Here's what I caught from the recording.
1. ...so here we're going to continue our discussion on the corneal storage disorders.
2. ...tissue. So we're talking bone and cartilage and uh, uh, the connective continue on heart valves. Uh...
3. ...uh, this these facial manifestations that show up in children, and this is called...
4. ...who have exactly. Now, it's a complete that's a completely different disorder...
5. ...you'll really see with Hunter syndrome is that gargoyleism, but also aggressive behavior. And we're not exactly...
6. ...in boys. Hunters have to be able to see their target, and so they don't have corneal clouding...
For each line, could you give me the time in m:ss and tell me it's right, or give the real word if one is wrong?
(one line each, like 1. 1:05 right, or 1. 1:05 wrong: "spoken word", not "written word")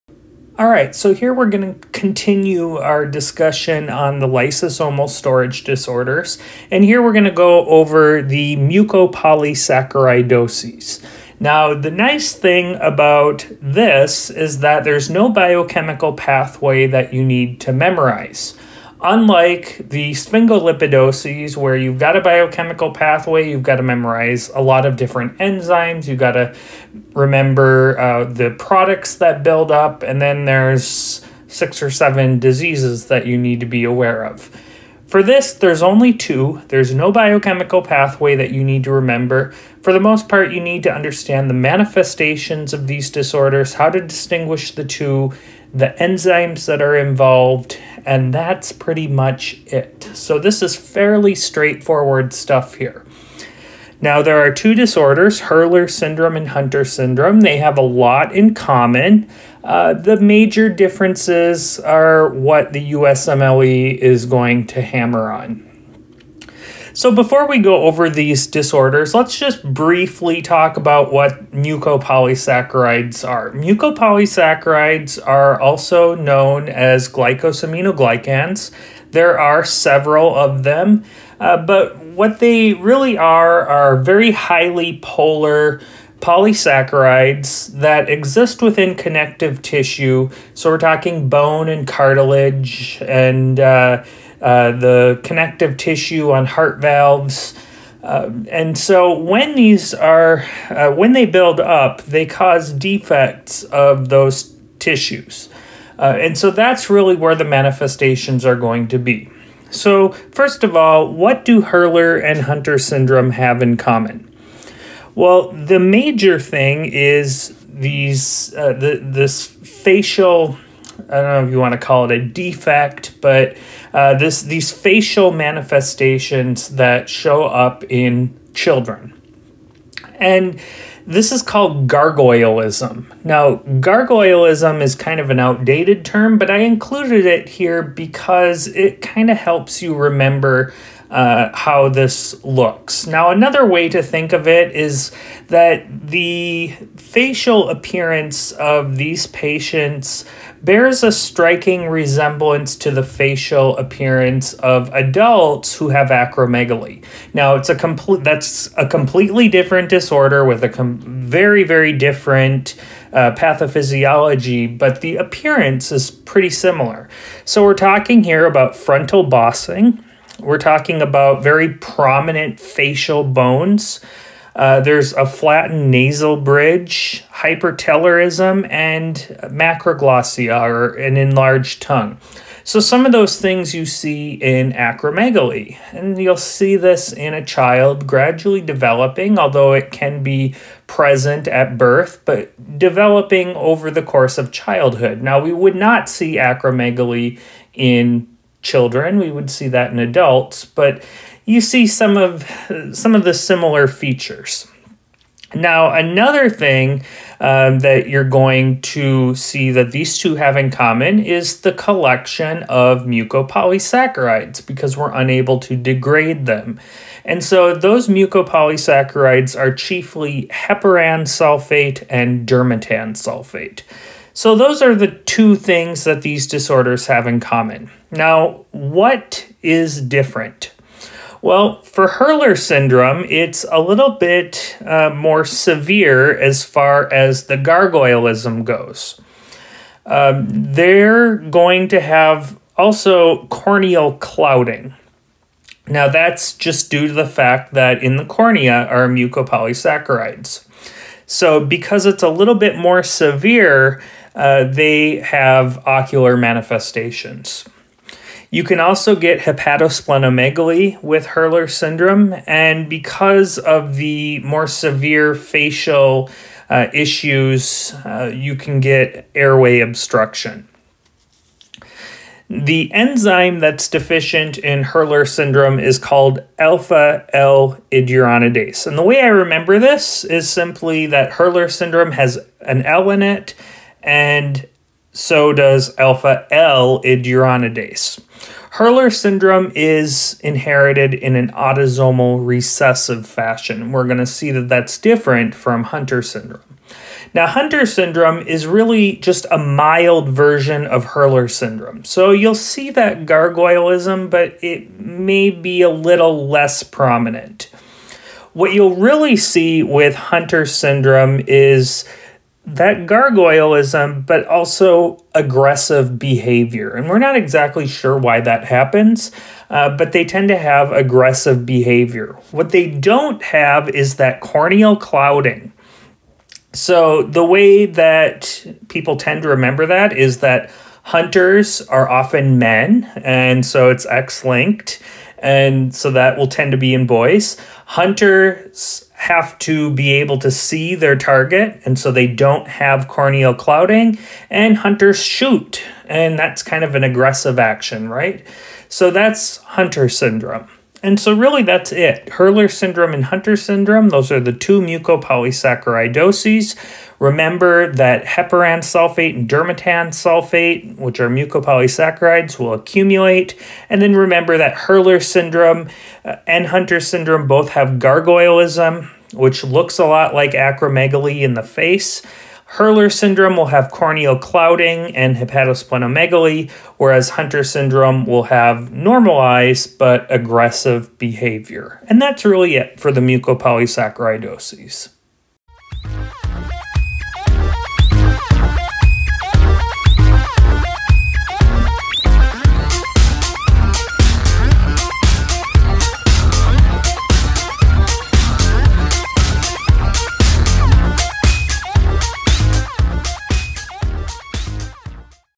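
1. 0:00 wrong: "lysosomal", not "corneal"
2. 1:29 wrong: "tissue", not "continue"
3. 2:03 right
4. 2:35 wrong: "acromegaly", not "exactly"
5. 5:08 right
6. 5:36 right.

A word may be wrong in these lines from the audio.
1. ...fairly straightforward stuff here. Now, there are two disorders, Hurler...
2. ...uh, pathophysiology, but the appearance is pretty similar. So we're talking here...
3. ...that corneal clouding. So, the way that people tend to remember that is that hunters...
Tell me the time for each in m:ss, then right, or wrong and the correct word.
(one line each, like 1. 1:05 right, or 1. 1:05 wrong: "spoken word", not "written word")
1. 0:50 right
2. 2:43 right
3. 5:24 right.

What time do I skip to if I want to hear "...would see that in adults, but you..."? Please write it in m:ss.
3:19.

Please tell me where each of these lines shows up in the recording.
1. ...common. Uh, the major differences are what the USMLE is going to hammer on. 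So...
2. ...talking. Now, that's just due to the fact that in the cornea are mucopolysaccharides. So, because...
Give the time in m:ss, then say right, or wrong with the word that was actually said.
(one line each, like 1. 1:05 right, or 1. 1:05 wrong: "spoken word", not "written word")
1. 0:58 right
2. 4:04 wrong: "clouding", not "talking".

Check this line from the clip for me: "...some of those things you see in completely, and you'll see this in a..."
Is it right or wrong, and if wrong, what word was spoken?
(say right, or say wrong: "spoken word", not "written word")
wrong: "acromegaly", not "completely".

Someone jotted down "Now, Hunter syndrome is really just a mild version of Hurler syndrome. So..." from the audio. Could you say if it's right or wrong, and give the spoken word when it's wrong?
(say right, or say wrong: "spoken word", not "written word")
right.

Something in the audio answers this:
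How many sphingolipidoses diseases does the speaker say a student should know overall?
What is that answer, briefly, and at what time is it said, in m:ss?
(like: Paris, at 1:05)
6 or 7, at 0:31.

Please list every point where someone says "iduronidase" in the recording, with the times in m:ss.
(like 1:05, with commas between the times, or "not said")
4:37, 4:47.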